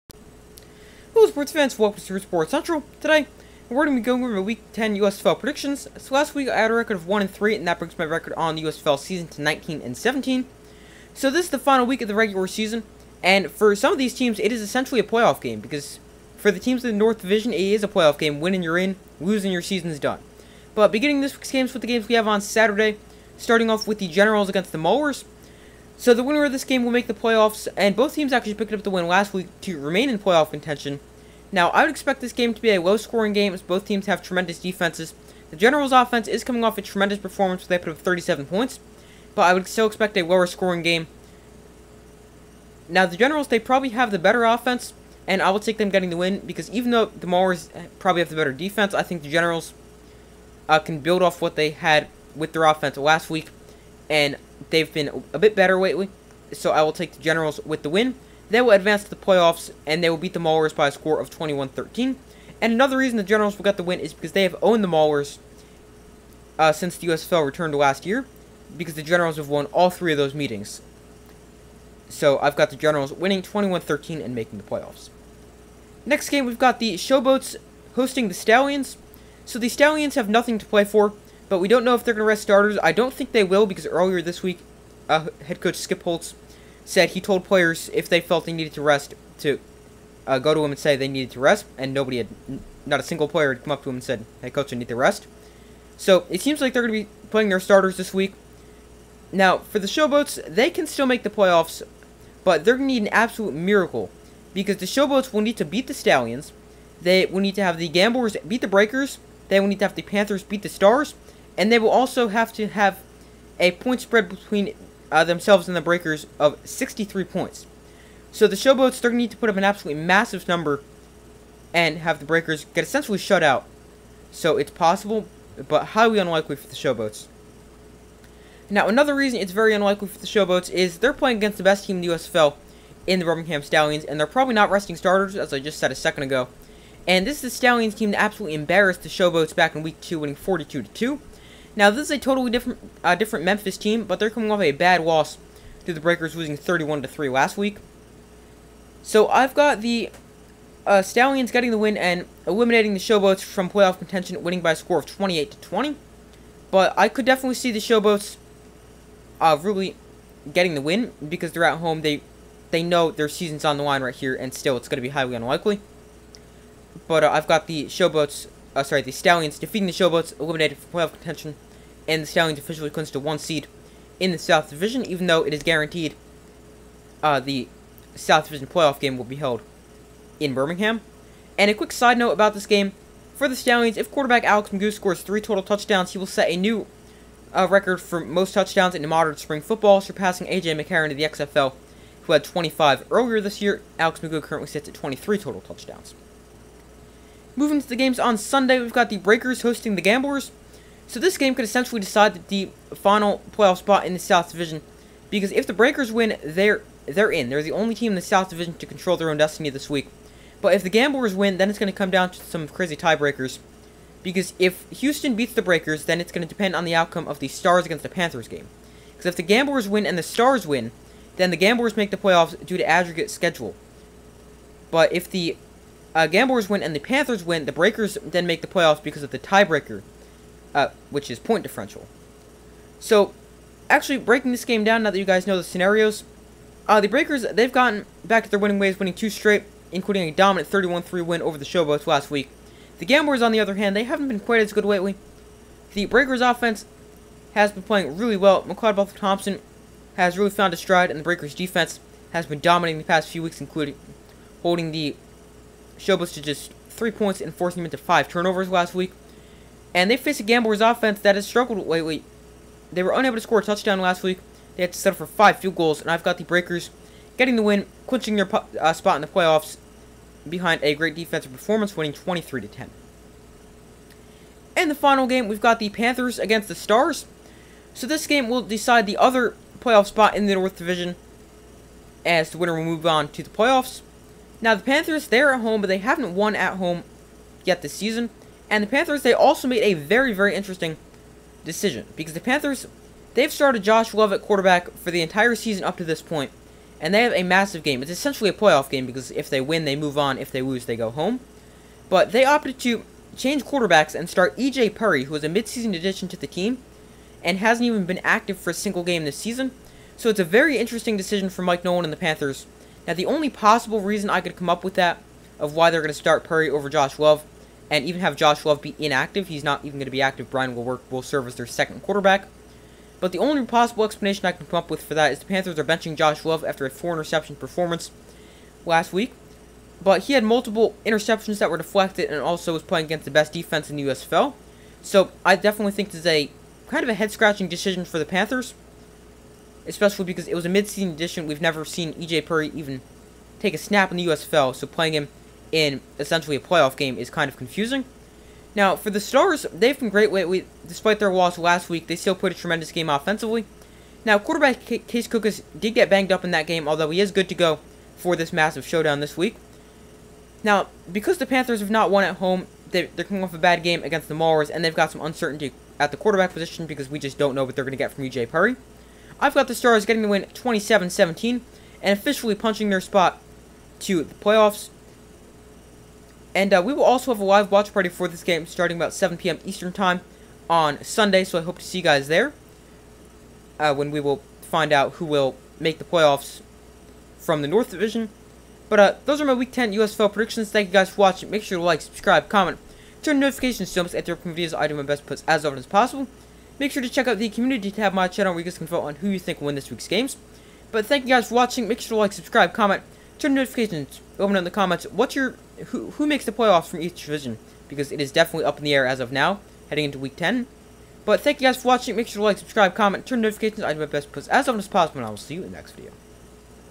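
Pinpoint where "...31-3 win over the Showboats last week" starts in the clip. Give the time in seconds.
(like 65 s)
240 s.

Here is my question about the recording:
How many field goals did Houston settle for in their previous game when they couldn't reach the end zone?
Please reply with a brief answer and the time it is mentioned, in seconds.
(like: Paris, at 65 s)
5, at 265 s.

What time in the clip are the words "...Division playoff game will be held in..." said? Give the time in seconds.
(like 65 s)
178 s.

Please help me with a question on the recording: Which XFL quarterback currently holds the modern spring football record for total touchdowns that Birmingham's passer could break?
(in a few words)
A.J. McCarron.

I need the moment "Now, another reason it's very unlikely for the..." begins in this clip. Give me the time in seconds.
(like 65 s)
128 s.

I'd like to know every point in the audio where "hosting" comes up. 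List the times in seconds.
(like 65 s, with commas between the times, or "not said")
77 s, 199 s.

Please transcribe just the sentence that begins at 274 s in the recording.
In the final game, we've got the Panthers against the Stars.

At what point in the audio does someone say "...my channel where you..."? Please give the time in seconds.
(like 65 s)
398 s.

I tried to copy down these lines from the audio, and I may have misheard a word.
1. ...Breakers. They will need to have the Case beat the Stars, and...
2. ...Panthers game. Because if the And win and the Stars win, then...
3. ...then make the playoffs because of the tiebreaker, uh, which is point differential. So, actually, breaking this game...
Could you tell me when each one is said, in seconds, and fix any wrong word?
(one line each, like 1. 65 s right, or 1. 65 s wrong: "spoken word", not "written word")
1. 108 s wrong: "Panthers", not "Case"
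2. 218 s wrong: "Gamblers", not "And"
3. 228 s right.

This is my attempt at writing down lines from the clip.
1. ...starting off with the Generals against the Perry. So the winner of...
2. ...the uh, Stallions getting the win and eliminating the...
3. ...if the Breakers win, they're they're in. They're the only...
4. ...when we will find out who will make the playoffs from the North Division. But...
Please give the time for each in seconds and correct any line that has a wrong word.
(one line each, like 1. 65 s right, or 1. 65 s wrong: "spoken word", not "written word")
1. 23 s wrong: "Maulers", not "Perry"
2. 149 s right
3. 205 s right
4. 383 s right.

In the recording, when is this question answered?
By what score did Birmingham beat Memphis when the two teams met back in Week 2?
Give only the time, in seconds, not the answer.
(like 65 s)
140 s.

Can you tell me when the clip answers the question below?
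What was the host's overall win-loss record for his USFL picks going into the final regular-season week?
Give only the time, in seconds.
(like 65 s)
9 s.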